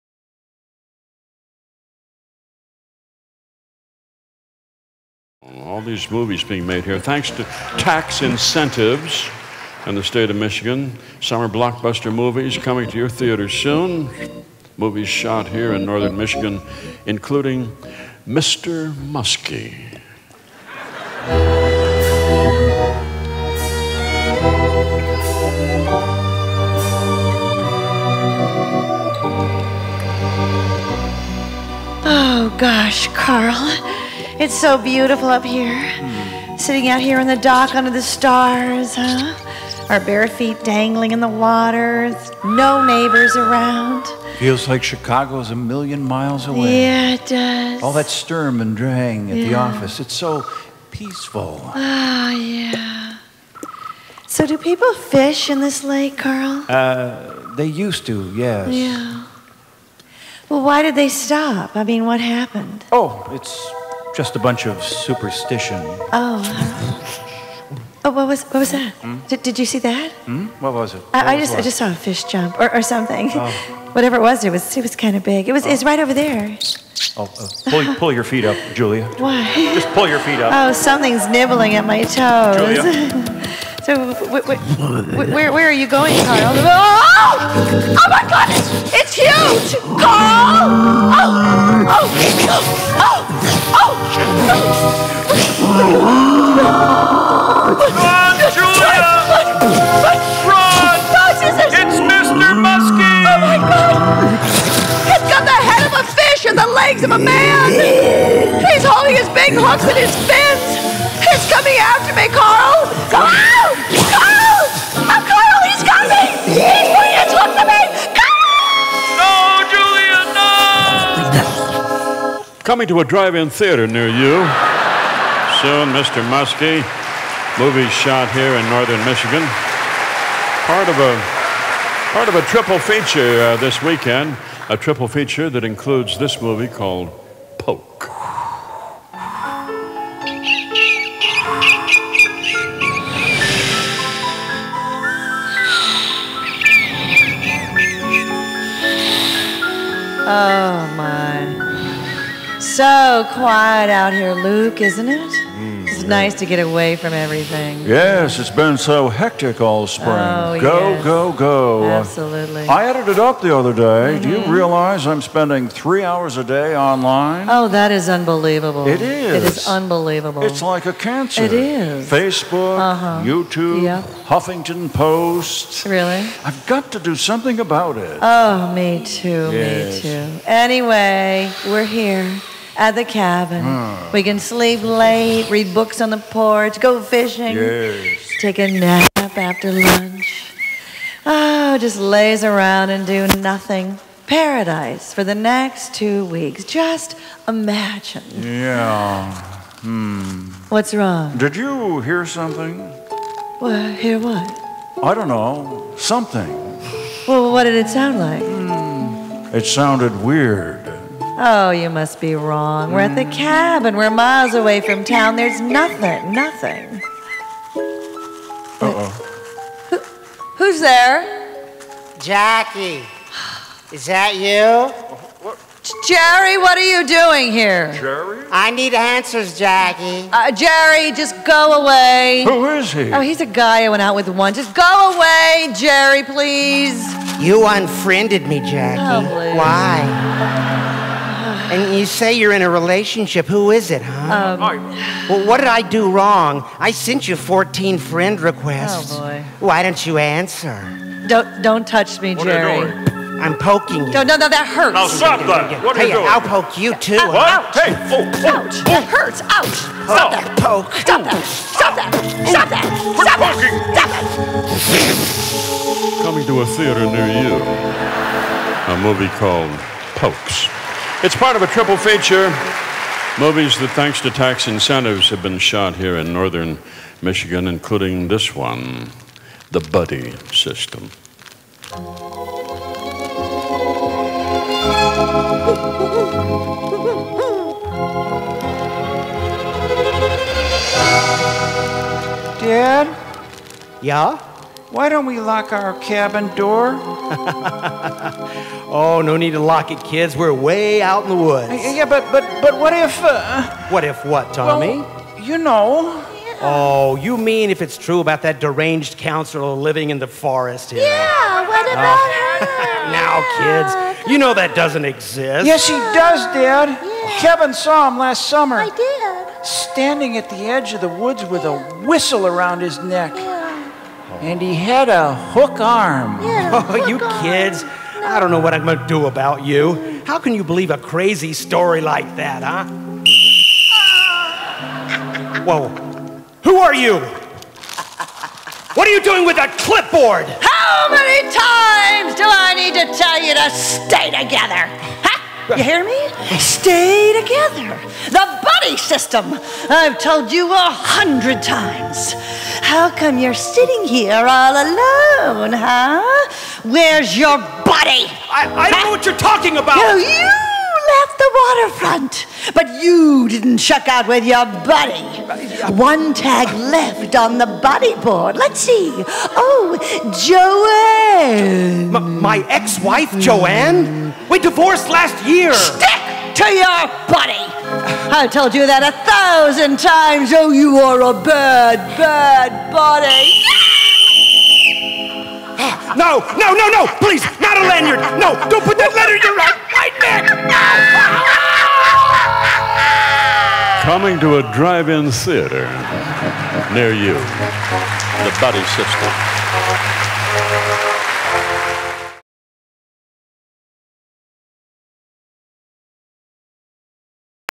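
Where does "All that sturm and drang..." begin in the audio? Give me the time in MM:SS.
00:47.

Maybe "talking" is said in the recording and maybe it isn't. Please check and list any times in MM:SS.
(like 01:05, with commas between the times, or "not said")
05:59.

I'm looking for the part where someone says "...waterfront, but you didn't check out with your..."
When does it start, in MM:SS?
06:02.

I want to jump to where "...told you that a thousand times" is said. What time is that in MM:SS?
06:18.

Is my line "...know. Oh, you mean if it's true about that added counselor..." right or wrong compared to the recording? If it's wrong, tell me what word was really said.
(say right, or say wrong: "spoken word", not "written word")
wrong: "deranged", not "added".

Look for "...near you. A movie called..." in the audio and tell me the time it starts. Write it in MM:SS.
04:27.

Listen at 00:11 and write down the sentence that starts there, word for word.
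Summer blockbuster movies coming to your theaters soon.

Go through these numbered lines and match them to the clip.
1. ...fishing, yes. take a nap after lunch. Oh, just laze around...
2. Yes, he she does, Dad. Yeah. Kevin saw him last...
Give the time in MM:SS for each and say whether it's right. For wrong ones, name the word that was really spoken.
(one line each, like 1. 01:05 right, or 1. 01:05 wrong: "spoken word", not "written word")
1. 03:06 right
2. 05:15 right.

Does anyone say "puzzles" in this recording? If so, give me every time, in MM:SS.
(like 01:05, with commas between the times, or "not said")
not said.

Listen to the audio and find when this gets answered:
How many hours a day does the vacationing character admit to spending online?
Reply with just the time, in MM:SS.
02:45.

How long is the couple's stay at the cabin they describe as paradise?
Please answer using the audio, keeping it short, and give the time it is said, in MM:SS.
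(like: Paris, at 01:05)
2 weeks, at 03:15.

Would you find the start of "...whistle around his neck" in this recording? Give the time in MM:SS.
05:22.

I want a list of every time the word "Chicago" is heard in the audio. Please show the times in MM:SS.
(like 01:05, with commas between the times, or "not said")
00:44.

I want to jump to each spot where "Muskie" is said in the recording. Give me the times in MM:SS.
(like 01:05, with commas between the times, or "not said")
00:18, 02:06.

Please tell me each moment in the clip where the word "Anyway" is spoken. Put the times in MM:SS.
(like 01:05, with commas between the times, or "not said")
03:00.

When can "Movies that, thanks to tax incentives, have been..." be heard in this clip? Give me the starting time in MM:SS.
04:33.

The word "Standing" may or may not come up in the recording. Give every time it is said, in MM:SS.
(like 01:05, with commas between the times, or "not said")
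05:19.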